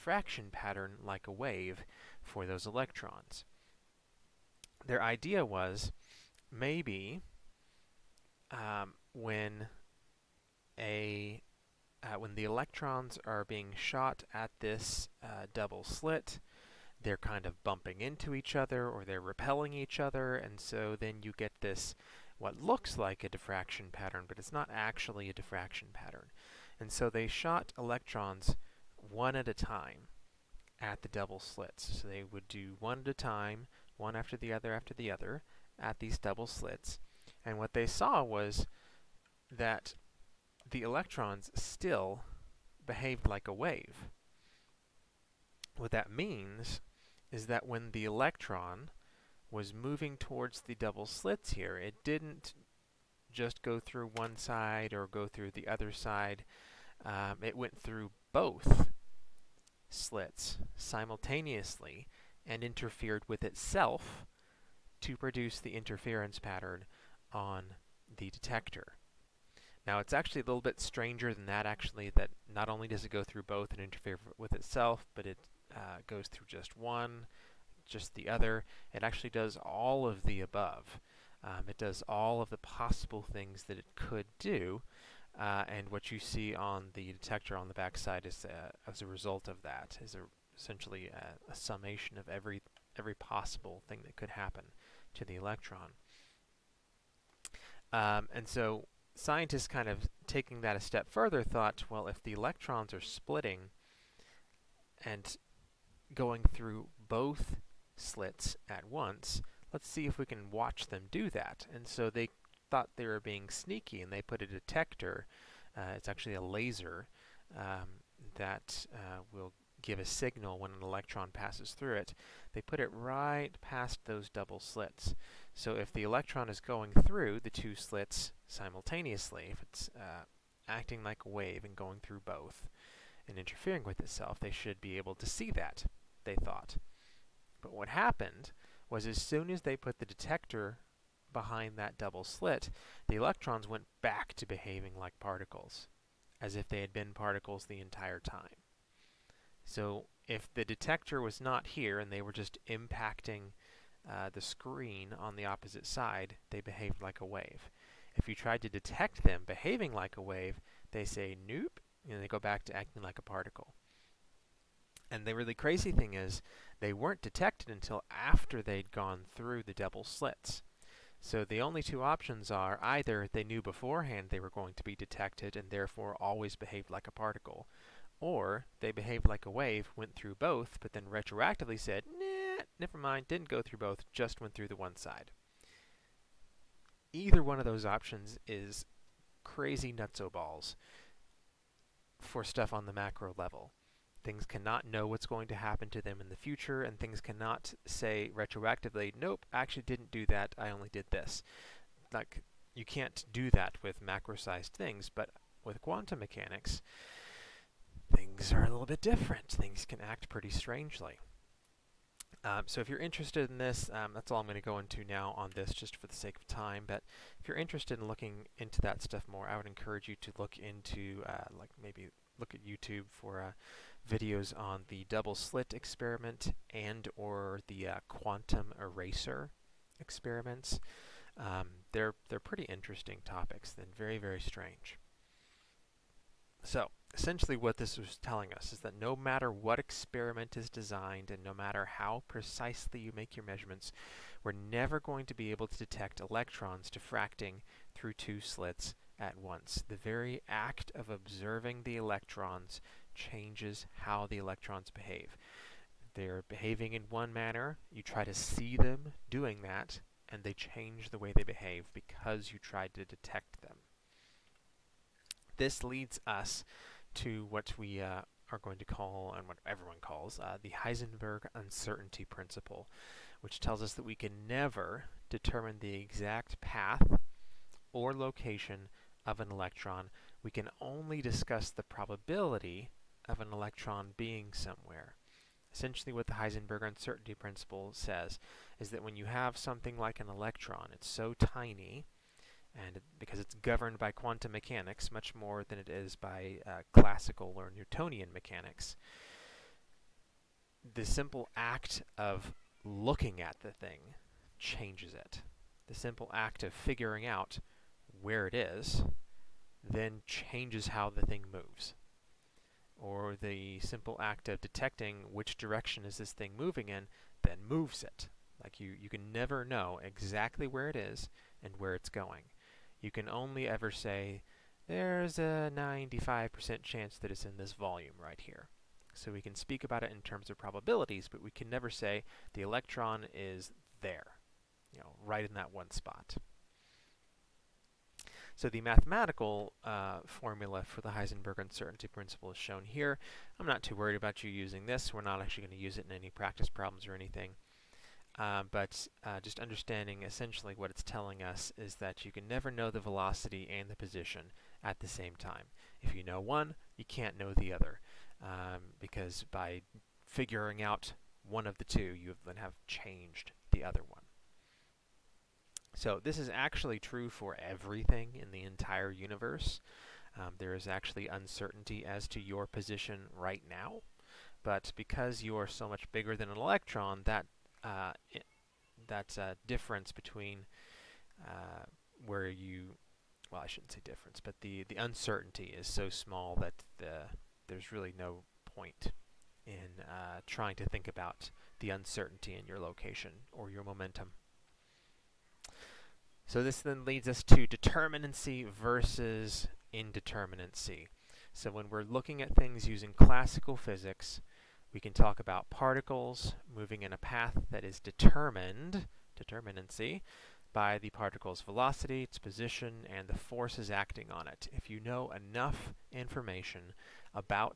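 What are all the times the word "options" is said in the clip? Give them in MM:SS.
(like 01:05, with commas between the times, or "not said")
02:52, 03:07.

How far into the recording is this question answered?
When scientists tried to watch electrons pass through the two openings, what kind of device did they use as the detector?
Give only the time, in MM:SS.
01:55.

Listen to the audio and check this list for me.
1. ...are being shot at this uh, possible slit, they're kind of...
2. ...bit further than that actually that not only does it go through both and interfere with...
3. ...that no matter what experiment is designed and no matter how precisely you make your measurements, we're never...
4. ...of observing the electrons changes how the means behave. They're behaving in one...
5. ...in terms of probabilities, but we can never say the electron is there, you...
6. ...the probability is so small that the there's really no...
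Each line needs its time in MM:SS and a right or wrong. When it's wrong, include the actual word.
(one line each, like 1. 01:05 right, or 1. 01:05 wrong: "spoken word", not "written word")
1. 00:13 wrong: "double", not "possible"
2. 01:10 wrong: "stranger", not "further"
3. 03:58 right
4. 04:10 wrong: "electrons", not "means"
5. 05:30 right
6. 06:24 wrong: "uncertainty", not "probability".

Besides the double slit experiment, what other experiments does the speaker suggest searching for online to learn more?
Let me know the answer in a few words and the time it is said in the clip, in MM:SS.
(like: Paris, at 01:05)
Quantum eraser experiments, at 03:48.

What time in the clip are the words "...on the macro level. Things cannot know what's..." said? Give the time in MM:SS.
03:12.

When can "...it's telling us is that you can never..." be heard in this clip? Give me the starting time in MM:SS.
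05:50.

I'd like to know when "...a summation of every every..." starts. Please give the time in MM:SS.
01:31.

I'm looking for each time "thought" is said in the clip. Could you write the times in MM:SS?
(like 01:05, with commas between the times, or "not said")
01:41, 01:52, 02:16.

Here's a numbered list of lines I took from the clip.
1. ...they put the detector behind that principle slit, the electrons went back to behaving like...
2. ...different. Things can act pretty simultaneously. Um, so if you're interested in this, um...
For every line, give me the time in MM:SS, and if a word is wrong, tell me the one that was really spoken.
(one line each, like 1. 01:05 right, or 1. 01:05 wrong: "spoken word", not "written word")
1. 02:19 wrong: "double", not "principle"
2. 03:29 wrong: "strangely", not "simultaneously".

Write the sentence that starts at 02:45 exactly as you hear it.
And the really crazy thing is, they weren't detected until after they'd gone through the double slits.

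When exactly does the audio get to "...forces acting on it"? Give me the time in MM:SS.
06:53.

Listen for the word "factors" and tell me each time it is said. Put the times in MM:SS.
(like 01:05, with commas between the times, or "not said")
not said.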